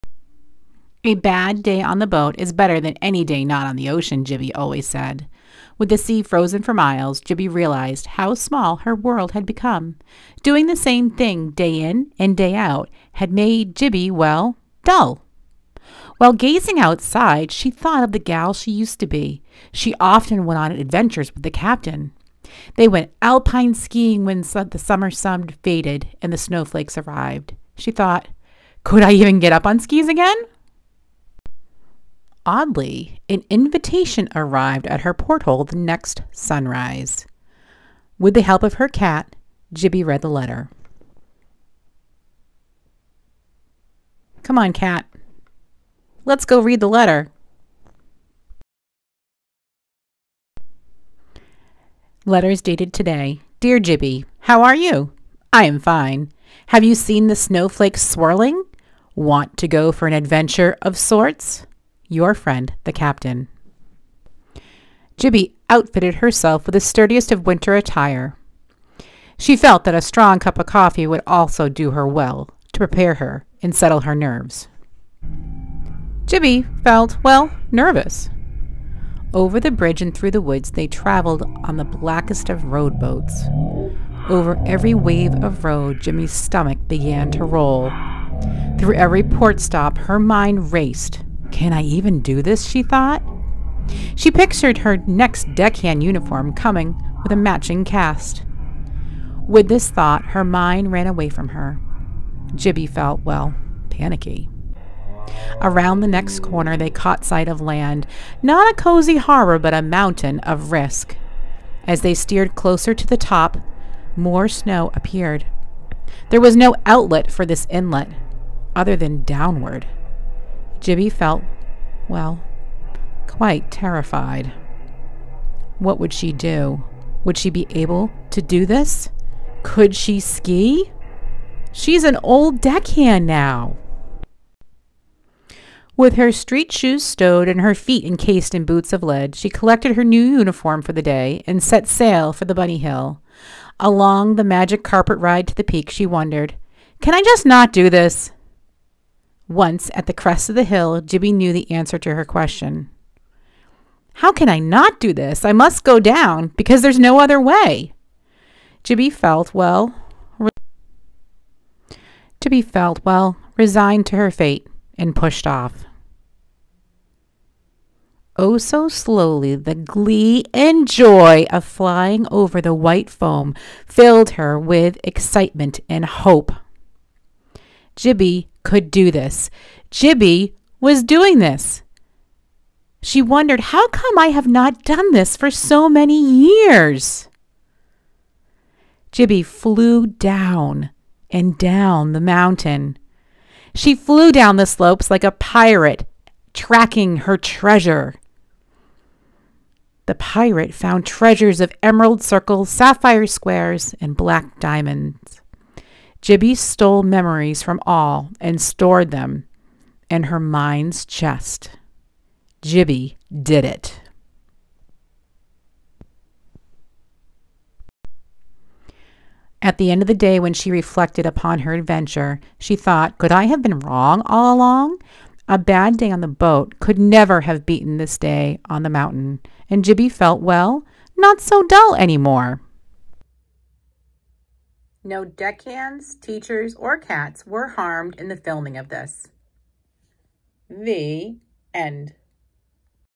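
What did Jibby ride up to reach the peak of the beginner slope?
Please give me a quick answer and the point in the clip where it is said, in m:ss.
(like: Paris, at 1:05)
Magic carpet, at 2:24.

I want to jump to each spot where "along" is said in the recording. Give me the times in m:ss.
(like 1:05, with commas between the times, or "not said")
2:23, 3:44.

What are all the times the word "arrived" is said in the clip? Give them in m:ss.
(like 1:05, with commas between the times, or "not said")
0:26, 0:34.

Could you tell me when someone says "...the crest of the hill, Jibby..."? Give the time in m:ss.
2:30.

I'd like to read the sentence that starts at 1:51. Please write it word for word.
As they steered closer to the top, more snow appeared.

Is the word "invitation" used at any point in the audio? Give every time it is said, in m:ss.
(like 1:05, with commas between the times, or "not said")
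0:33.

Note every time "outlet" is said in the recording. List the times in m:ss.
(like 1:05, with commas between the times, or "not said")
1:56.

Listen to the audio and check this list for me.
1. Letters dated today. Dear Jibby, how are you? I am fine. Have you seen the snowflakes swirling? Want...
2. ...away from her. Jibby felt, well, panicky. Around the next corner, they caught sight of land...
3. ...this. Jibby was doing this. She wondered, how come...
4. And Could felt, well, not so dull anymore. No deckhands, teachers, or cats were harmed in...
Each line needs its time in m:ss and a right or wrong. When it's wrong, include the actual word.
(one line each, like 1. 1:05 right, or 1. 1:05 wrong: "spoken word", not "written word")
1. 0:52 right
2. 1:41 right
3. 2:59 right
4. 3:49 wrong: "Jibby", not "Could".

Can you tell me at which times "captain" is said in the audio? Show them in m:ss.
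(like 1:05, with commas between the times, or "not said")
0:21, 1:02.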